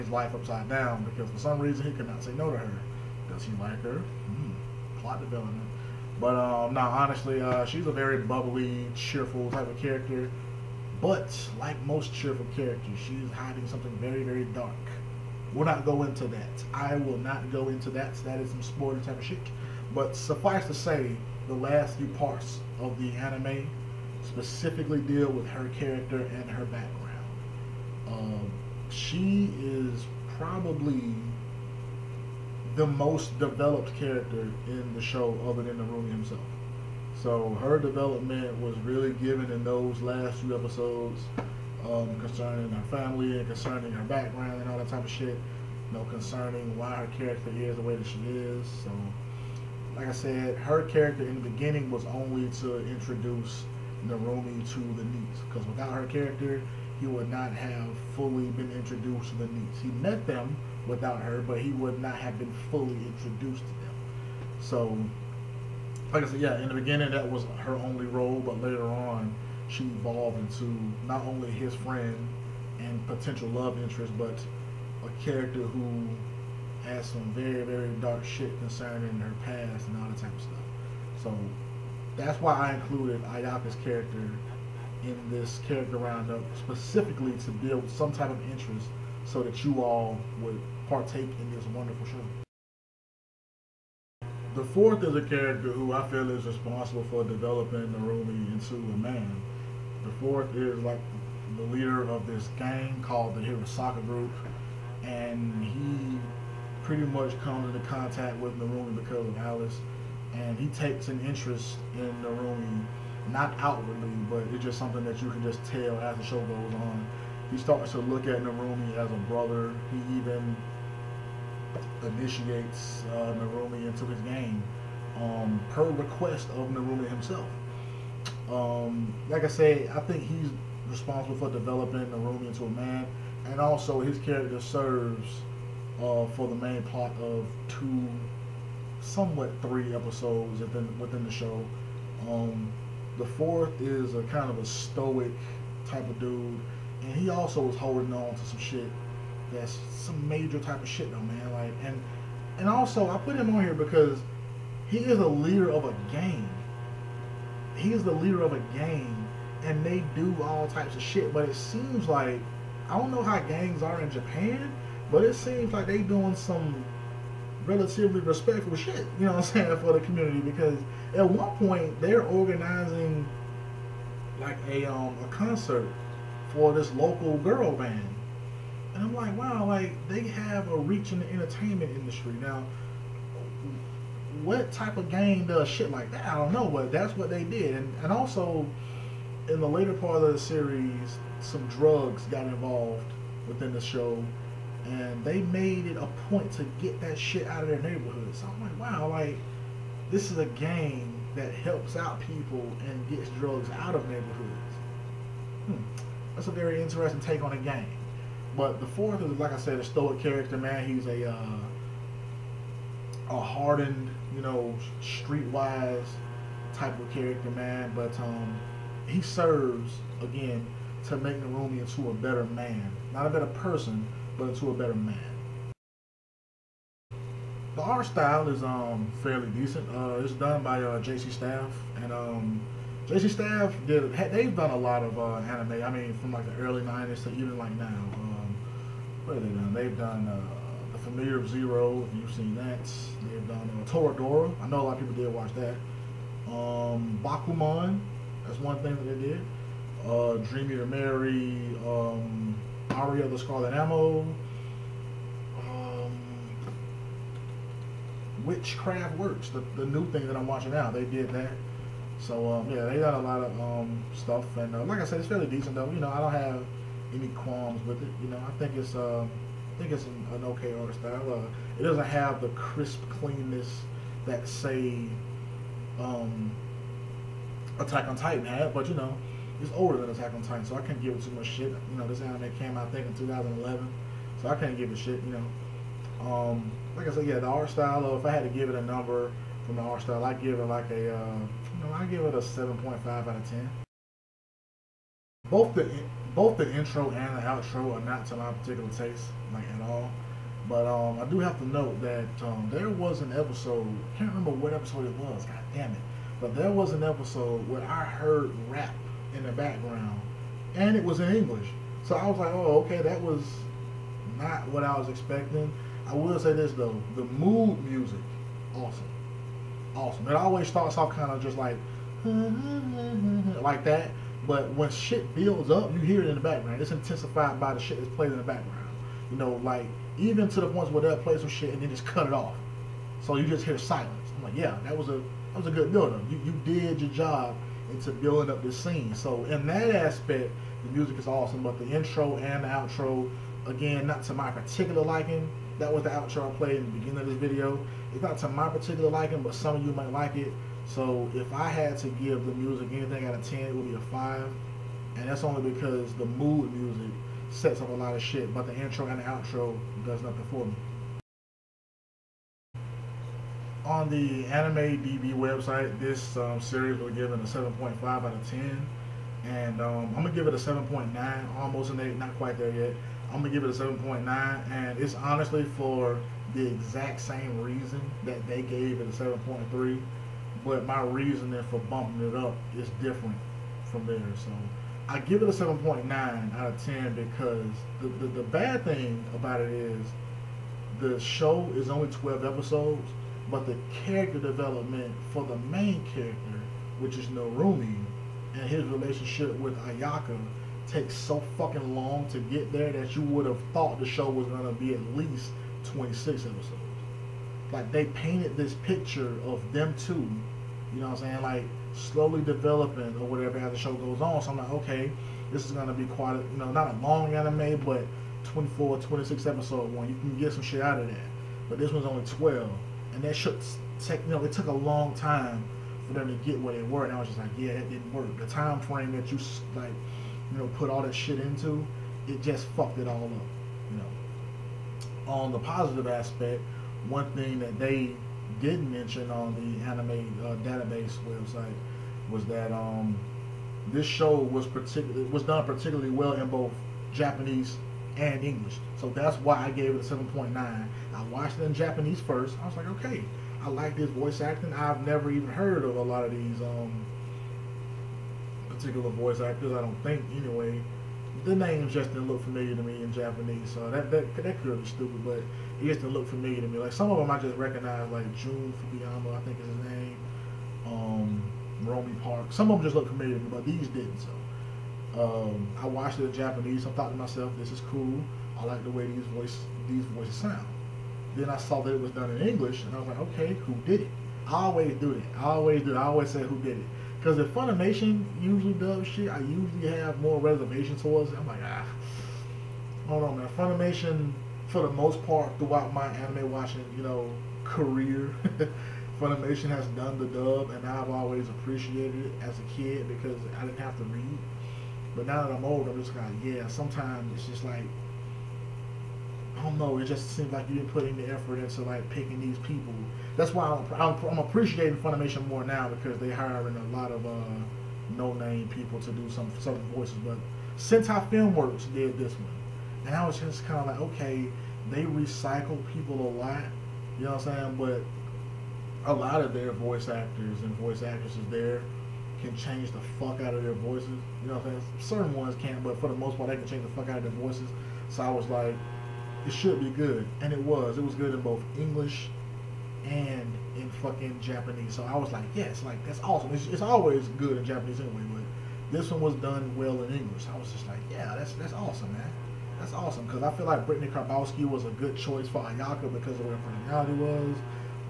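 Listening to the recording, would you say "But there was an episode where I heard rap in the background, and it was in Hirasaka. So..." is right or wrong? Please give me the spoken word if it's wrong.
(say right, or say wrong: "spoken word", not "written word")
wrong: "English", not "Hirasaka".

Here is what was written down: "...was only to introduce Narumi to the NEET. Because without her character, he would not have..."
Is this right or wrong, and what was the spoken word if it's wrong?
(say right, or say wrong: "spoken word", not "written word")
right.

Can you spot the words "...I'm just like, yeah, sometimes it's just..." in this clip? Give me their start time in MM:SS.
08:25.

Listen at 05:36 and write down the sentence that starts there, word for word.
You, you did your job into building up this scene.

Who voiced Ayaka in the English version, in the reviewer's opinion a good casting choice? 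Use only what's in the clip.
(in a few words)
Brittney Karbowski.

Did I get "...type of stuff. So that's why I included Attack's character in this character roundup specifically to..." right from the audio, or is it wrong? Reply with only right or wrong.
wrong.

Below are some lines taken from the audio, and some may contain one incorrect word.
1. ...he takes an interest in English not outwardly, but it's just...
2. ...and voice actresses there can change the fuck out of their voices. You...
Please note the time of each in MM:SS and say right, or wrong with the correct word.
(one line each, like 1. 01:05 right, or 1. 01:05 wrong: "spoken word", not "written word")
1. 01:50 wrong: "Narumi", not "English"
2. 08:50 right.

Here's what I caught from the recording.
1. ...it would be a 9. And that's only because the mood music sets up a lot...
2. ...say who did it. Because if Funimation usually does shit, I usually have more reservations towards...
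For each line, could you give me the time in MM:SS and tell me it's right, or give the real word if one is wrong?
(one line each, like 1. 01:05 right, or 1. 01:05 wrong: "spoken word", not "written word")
1. 05:53 wrong: "5", not "9"
2. 08:06 right.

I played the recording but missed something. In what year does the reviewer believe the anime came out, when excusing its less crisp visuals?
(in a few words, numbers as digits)
2011.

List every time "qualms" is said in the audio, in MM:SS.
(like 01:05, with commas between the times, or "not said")
04:27.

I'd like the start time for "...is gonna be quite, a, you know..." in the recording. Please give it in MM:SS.
06:55.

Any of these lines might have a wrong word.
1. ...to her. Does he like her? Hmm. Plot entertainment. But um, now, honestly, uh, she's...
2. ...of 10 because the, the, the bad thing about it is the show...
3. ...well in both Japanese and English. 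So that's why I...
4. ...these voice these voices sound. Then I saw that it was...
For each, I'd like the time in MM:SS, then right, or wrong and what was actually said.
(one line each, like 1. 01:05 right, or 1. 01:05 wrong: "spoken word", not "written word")
1. 00:02 wrong: "development", not "entertainment"
2. 06:26 right
3. 07:26 right
4. 07:59 right.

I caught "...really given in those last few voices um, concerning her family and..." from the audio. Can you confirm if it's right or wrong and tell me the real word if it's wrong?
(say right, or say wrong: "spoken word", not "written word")
wrong: "episodes", not "voices".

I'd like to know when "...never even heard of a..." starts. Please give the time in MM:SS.
07:35.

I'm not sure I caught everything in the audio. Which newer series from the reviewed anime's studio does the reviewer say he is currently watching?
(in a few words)
Witchcraft Works.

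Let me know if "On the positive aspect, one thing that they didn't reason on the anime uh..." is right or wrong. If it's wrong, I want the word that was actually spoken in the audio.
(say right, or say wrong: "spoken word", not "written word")
wrong: "mention", not "reason".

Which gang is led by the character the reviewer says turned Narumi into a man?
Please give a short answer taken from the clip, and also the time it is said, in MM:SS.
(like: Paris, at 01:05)
Hirasaka Group, at 01:43.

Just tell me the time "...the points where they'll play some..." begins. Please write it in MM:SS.
05:30.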